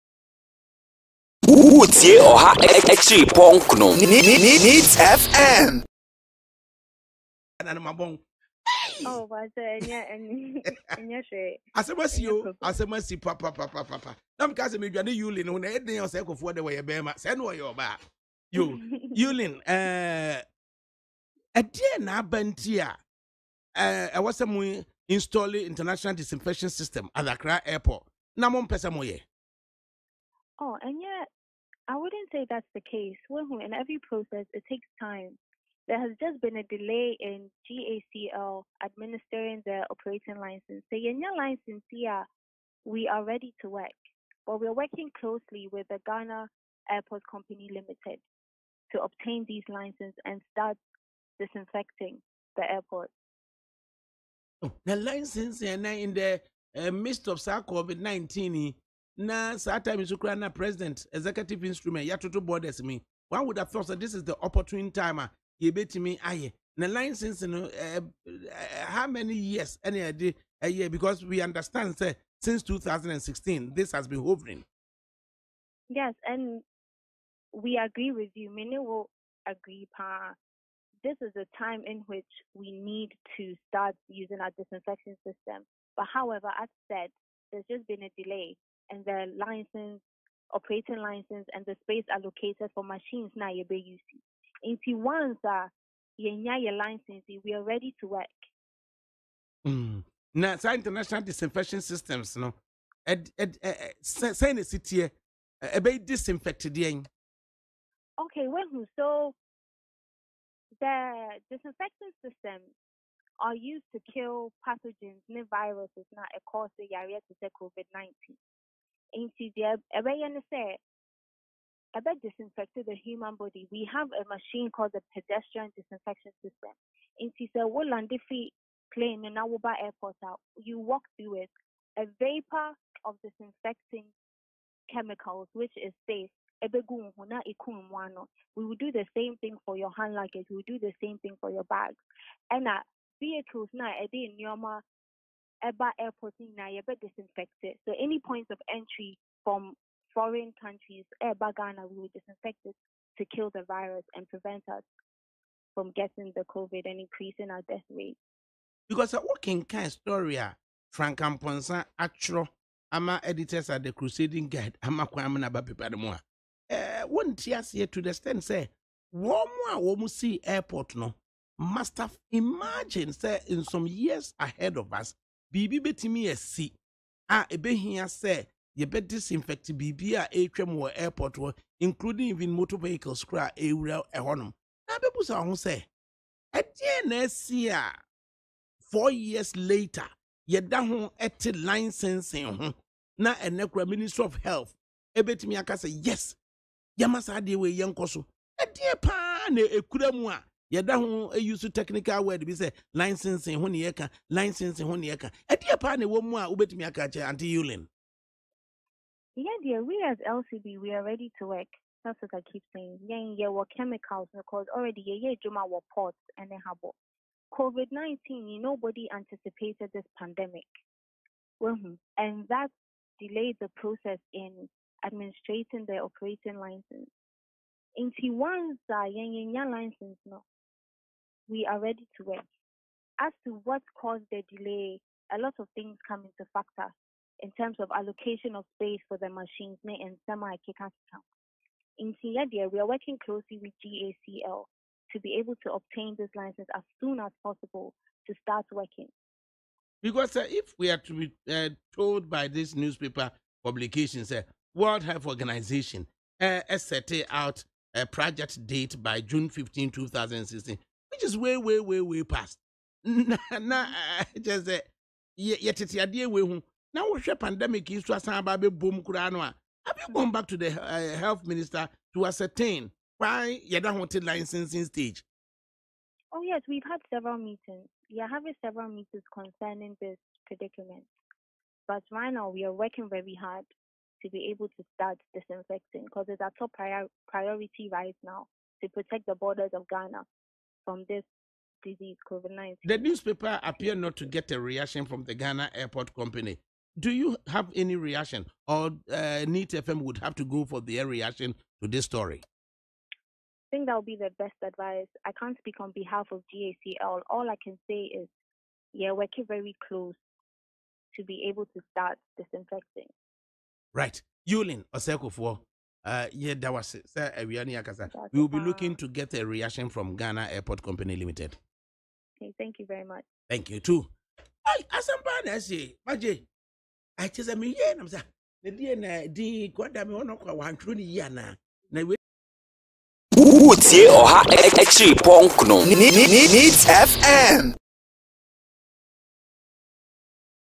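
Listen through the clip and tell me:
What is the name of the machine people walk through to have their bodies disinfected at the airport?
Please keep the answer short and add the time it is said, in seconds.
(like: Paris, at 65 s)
pedestrian disinfection system, at 125 s.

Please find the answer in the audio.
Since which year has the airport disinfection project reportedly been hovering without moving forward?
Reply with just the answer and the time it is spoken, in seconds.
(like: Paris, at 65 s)
2016, at 72 s.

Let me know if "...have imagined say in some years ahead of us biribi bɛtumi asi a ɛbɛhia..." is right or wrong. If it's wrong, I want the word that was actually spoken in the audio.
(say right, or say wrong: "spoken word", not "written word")
right.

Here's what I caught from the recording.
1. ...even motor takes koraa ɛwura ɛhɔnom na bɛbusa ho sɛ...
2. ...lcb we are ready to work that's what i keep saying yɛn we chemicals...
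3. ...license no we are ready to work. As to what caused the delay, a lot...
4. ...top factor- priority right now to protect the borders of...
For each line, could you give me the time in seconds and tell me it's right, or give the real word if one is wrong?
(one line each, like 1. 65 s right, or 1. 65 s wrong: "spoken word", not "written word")
1. 182 s wrong: "vehicles", not "takes"
2. 210 s right
3. 229 s right
4. 286 s wrong: "prior", not "factor".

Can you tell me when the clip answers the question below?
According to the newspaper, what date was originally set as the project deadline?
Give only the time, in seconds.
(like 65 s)
259 s.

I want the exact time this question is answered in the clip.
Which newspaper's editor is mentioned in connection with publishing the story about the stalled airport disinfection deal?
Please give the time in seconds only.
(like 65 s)
163 s.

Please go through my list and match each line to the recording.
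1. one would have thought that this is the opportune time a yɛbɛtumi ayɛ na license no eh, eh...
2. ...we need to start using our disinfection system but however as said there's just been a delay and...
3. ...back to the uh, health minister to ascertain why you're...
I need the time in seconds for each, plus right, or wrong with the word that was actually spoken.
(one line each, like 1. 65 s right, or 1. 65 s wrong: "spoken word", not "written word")
1. 63 s right
2. 82 s right
3. 270 s right.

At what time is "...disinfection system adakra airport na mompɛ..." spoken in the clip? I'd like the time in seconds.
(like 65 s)
26 s.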